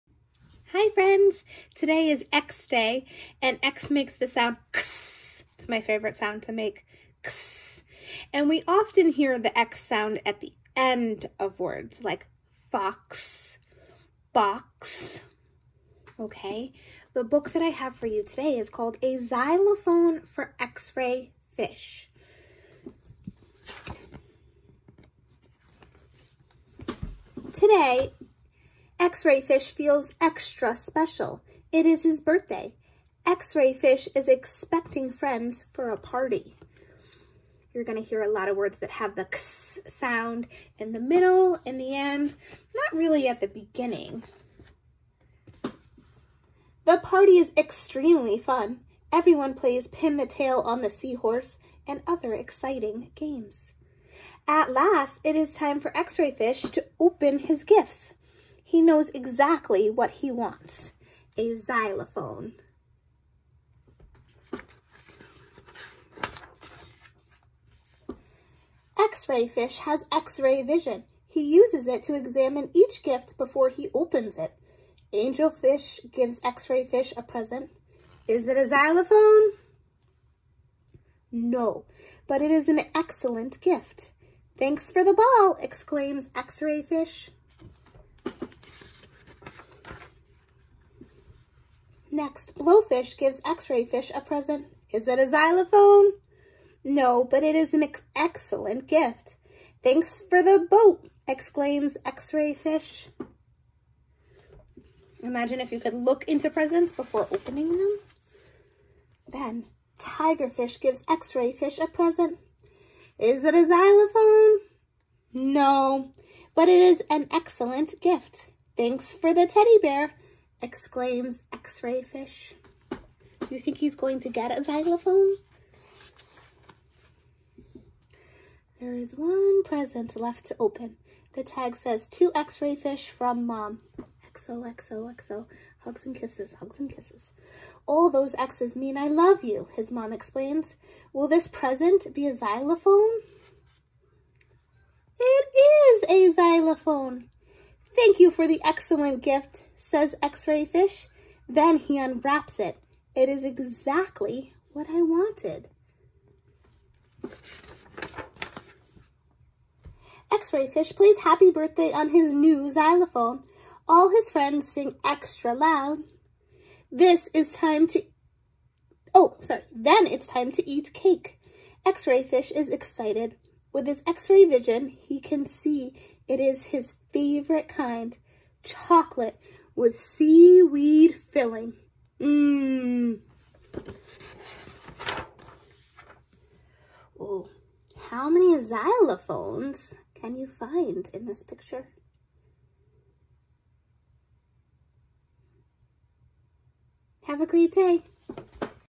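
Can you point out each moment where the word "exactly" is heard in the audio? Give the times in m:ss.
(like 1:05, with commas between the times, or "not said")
0:59, 2:33.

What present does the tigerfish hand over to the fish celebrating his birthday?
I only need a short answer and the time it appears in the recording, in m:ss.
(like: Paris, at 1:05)
Teddy bear, at 1:59.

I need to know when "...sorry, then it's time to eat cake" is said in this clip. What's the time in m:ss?
2:49.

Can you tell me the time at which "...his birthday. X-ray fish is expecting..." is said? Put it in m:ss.
0:32.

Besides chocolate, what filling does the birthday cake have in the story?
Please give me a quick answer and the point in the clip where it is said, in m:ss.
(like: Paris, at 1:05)
Seaweed, at 2:59.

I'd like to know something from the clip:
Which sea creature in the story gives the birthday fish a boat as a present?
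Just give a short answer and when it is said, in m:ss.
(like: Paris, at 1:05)
Blowfish, at 1:32.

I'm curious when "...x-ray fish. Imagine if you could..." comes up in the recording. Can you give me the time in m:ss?
1:42.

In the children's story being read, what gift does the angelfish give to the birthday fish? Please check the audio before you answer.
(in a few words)
Ball.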